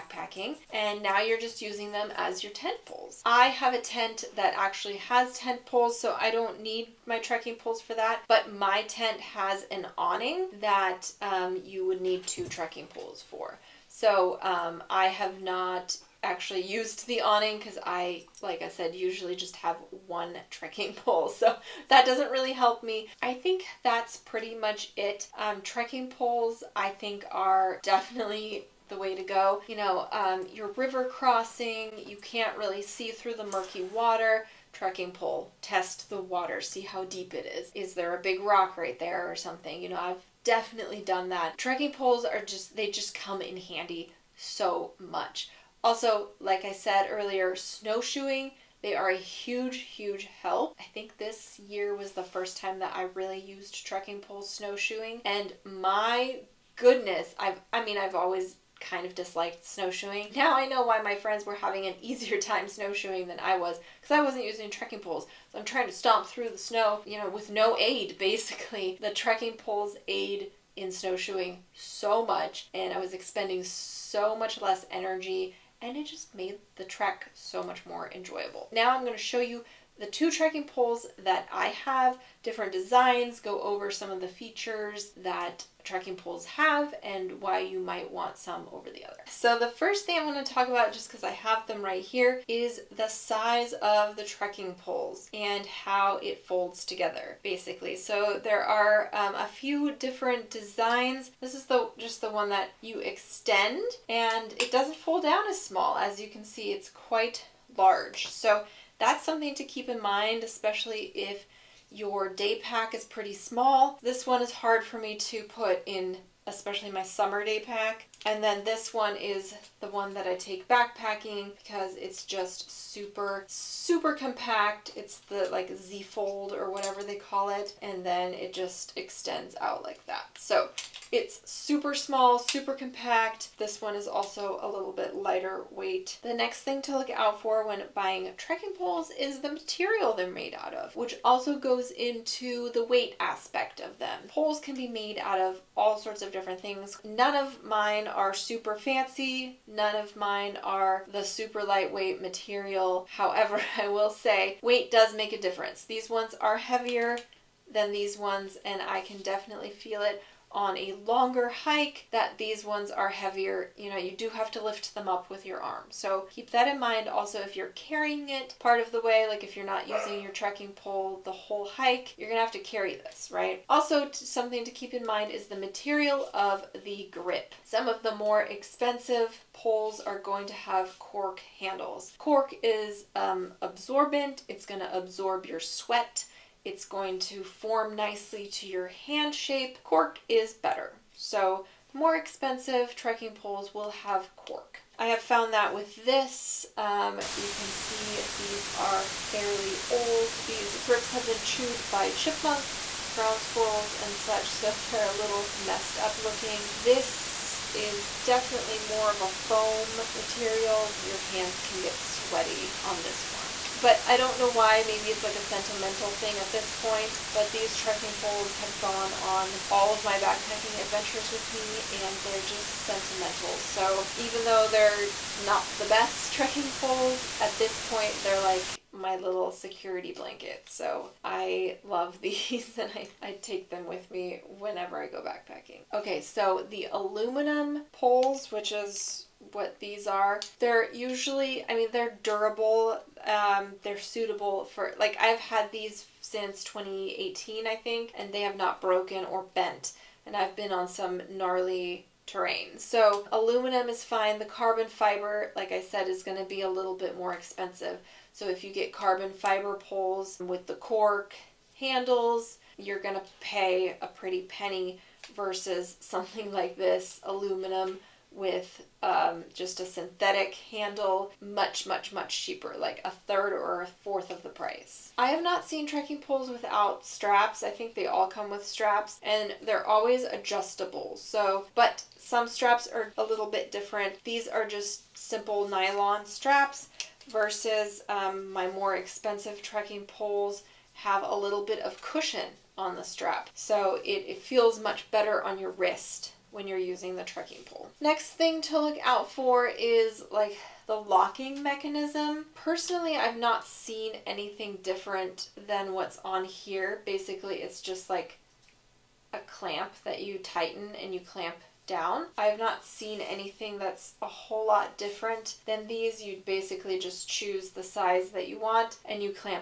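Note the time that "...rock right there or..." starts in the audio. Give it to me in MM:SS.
00:38.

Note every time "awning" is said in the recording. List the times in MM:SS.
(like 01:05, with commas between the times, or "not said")
00:09, 00:17.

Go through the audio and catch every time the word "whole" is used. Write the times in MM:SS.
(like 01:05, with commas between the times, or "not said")
02:51, 05:14.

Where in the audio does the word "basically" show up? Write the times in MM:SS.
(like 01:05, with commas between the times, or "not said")
01:08, 01:37, 05:07, 05:16.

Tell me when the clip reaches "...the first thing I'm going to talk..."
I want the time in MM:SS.
01:29.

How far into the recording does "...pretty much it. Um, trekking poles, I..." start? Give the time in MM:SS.
00:24.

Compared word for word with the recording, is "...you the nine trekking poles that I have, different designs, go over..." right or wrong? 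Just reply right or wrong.
wrong.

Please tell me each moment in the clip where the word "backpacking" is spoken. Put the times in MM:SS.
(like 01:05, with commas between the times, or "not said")
02:00, 03:40, 03:55.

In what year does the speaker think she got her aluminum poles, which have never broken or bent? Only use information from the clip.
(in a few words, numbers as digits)
2018.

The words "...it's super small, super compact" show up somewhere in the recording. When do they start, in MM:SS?
02:11.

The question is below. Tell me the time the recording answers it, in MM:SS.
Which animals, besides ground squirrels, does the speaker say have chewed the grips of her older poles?
03:22.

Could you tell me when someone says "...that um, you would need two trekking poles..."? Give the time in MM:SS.
00:10.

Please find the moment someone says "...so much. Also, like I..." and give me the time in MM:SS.
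00:44.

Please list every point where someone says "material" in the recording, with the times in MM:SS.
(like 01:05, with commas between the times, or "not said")
02:19, 02:32, 02:55, 03:30.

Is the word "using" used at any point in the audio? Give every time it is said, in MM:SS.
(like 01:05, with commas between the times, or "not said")
00:01, 01:04, 02:49, 04:56.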